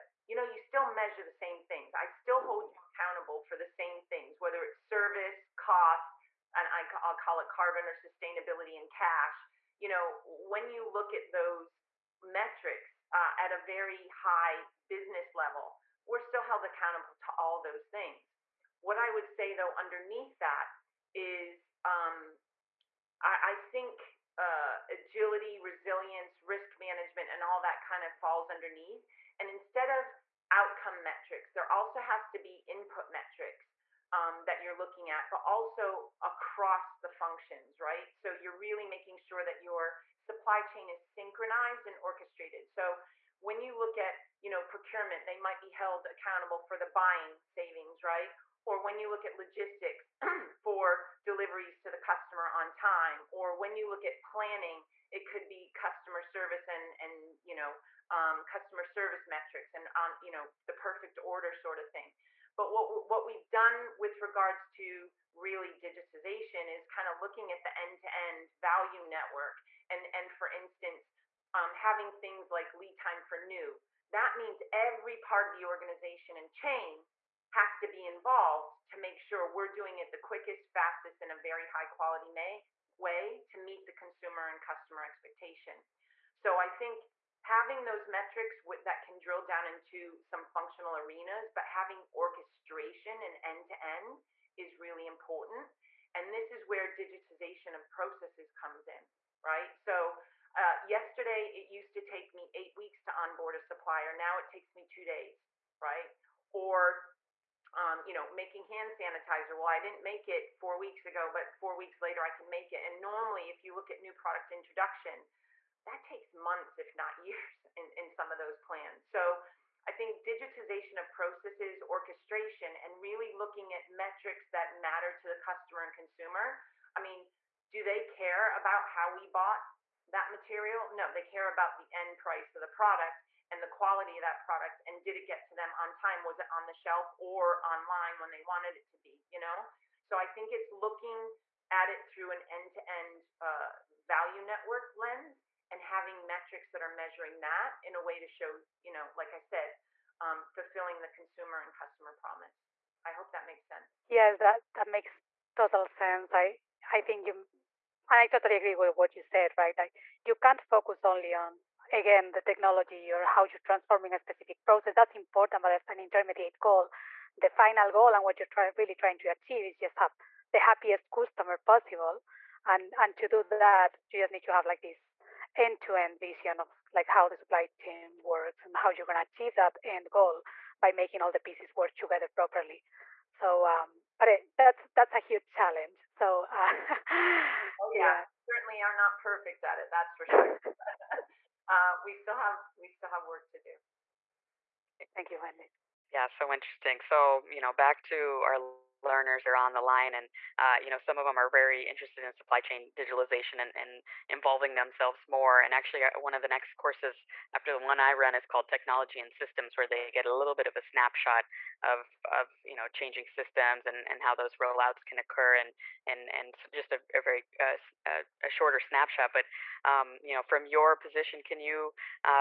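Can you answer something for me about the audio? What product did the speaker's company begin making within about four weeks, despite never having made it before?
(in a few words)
hand sanitizer.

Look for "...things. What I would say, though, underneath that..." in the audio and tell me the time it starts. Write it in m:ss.
0:17.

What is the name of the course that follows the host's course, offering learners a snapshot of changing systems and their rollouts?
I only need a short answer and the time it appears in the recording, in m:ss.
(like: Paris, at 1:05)
Technology and Systems, at 3:28.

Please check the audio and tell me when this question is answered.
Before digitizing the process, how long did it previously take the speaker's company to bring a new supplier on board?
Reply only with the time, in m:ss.
1:42.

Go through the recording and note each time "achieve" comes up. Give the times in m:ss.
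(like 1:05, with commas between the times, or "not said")
2:49, 2:59.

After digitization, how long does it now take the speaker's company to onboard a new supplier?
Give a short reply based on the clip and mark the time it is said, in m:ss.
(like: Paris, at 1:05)
2 days, at 1:44.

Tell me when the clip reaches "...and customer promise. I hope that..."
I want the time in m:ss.
2:31.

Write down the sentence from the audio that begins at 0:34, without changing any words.
Um, that you're looking at, but also across the functions, right?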